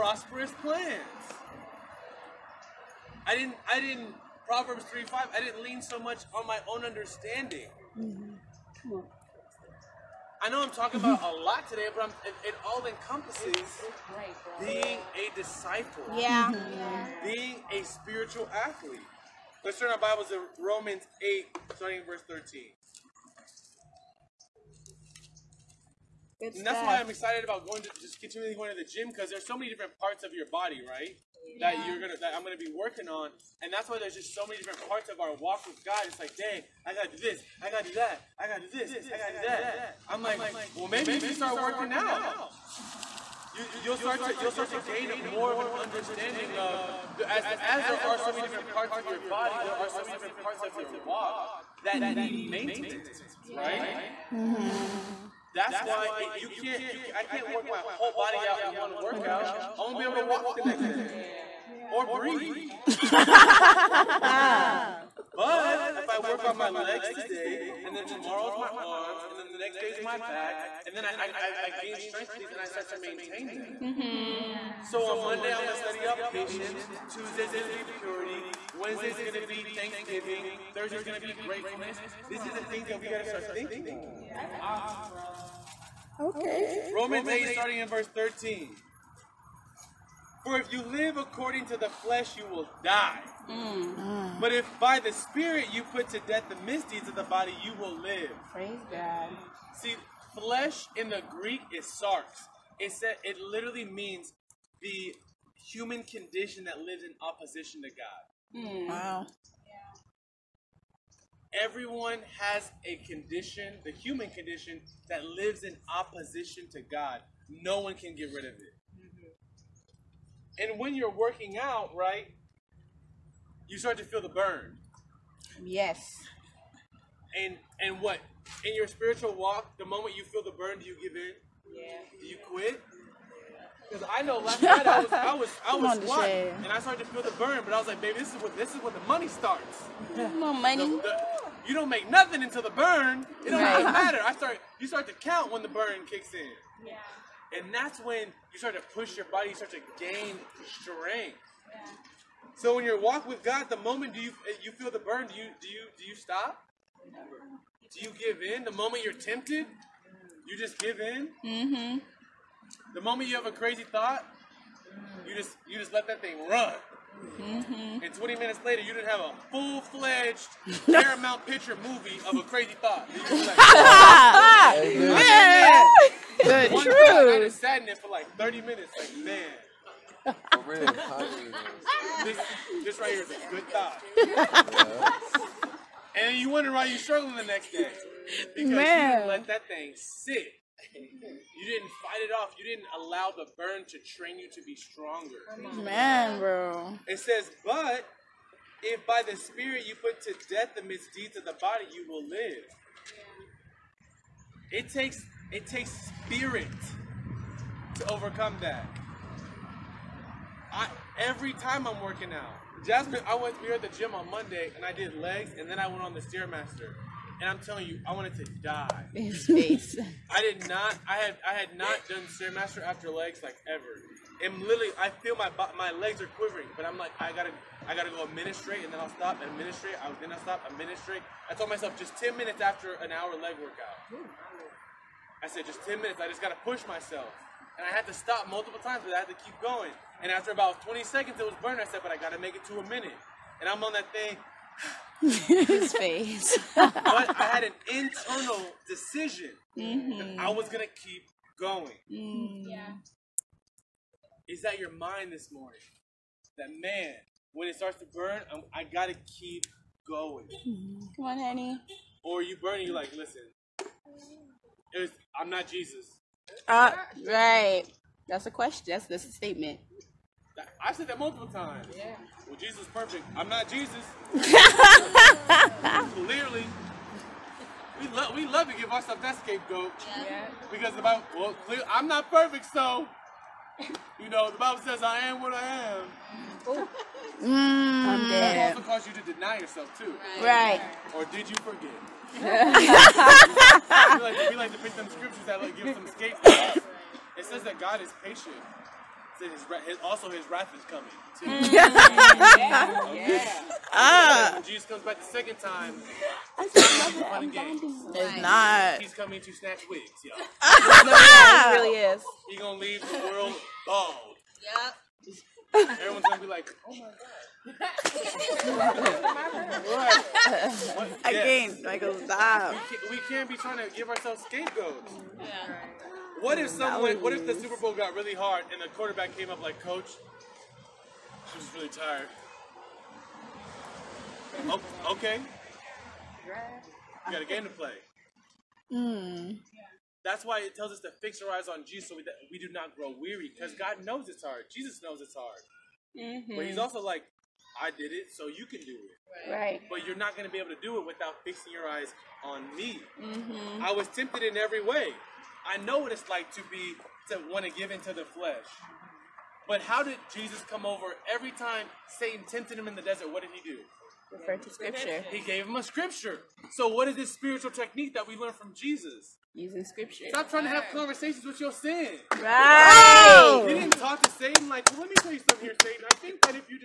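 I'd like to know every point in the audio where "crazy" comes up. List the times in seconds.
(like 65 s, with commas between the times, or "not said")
163 s, 172 s.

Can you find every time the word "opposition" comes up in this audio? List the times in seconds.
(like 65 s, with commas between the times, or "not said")
107 s, 115 s.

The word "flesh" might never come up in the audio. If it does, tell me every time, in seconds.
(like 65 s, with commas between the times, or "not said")
91 s, 100 s, 358 s.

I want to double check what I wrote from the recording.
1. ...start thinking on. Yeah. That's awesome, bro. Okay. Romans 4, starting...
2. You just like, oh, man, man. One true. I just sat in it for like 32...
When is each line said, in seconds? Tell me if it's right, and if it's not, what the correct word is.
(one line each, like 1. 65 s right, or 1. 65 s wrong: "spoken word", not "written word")
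1. 83 s wrong: "8", not "4"
2. 173 s wrong: "30", not "32".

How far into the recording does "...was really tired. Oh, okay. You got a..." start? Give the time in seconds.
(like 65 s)
331 s.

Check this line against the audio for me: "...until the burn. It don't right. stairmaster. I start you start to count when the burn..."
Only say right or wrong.
wrong.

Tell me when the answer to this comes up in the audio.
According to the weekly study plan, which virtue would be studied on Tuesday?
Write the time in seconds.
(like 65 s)
77 s.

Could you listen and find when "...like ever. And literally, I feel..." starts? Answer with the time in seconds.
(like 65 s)
223 s.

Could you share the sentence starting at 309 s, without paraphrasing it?
He's coming to snatch wigs, y'all.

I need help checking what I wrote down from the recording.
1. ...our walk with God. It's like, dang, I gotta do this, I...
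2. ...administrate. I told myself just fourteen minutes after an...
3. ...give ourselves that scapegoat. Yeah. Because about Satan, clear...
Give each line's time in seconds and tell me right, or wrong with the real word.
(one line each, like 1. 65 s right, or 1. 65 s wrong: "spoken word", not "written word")
1. 35 s right
2. 230 s wrong: "ten", not "fourteen"
3. 278 s wrong: "Well", not "Satan".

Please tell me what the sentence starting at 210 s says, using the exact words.
I every time I'm working out.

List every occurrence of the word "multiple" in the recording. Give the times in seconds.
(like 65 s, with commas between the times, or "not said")
238 s, 271 s.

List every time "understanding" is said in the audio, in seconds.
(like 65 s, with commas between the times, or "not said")
6 s, 45 s.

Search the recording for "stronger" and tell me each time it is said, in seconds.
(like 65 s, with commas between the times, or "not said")
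194 s.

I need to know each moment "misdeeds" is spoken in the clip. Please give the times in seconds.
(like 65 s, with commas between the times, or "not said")
96 s, 200 s.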